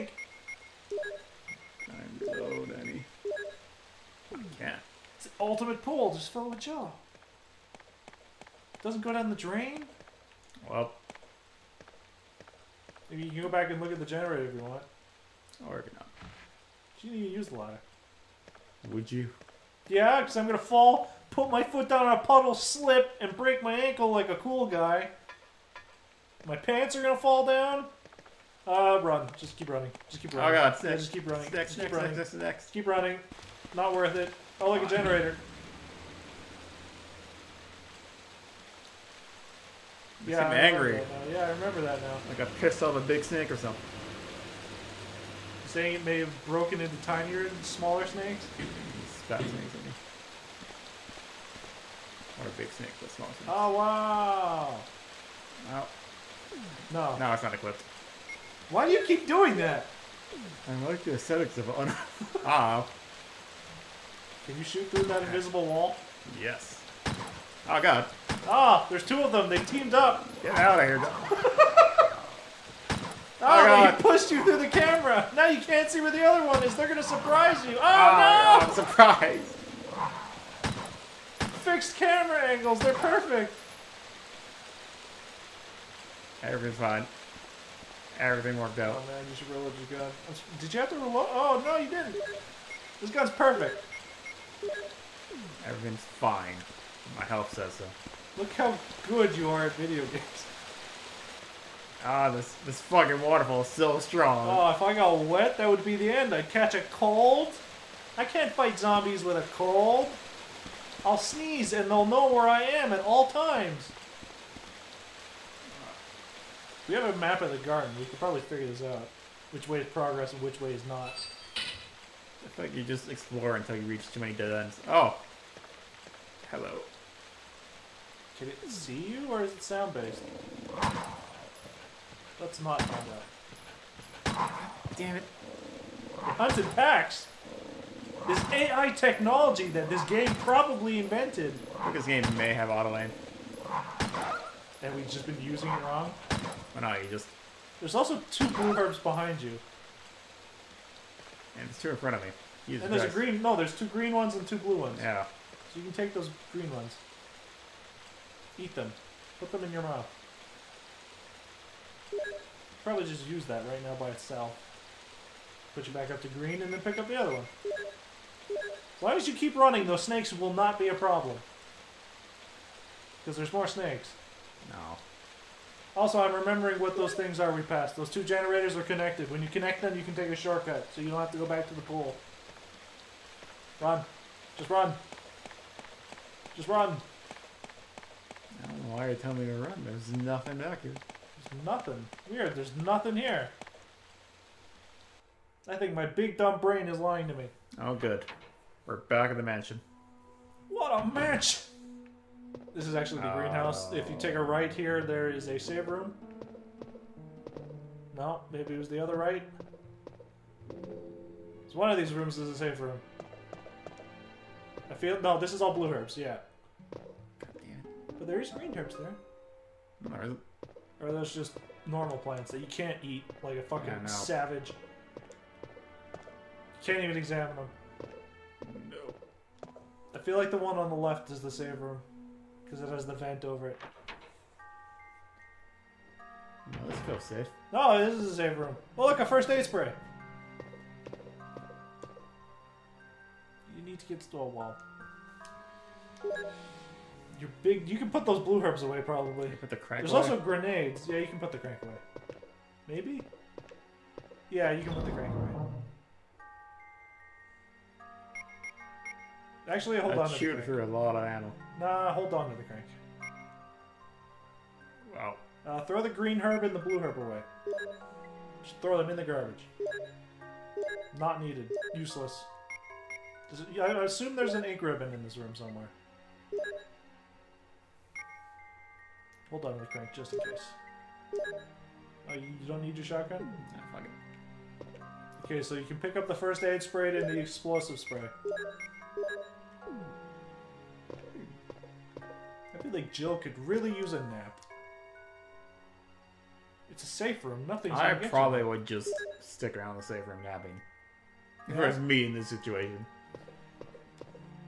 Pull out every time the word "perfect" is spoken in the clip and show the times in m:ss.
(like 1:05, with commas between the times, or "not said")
1:22, 1:33.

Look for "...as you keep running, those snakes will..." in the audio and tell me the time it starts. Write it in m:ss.
2:49.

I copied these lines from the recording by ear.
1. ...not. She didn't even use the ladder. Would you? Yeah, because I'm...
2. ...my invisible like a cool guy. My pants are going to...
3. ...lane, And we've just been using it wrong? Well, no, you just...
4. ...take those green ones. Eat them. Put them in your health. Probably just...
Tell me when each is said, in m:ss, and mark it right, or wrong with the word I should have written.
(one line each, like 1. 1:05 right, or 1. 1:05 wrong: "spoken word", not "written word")
1. 0:15 right
2. 0:23 wrong: "ankle", not "invisible"
3. 2:22 right
4. 2:35 wrong: "mouth", not "health".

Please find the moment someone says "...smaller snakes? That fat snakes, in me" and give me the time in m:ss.
0:47.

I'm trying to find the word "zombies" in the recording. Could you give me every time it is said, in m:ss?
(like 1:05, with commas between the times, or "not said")
1:48.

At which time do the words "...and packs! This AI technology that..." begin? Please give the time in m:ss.
2:16.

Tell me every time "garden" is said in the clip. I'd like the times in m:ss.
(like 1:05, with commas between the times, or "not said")
1:57.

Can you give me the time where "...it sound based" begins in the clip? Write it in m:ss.
2:09.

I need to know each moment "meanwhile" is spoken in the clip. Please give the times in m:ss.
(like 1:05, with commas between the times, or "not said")
not said.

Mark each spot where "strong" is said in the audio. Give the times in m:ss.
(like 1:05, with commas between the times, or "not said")
1:43.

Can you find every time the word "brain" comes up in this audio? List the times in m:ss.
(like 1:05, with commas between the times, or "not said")
3:16.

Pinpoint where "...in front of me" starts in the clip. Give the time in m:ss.
2:31.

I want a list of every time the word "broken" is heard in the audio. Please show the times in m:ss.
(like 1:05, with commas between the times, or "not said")
0:46.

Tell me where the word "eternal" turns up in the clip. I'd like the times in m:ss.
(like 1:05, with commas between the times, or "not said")
not said.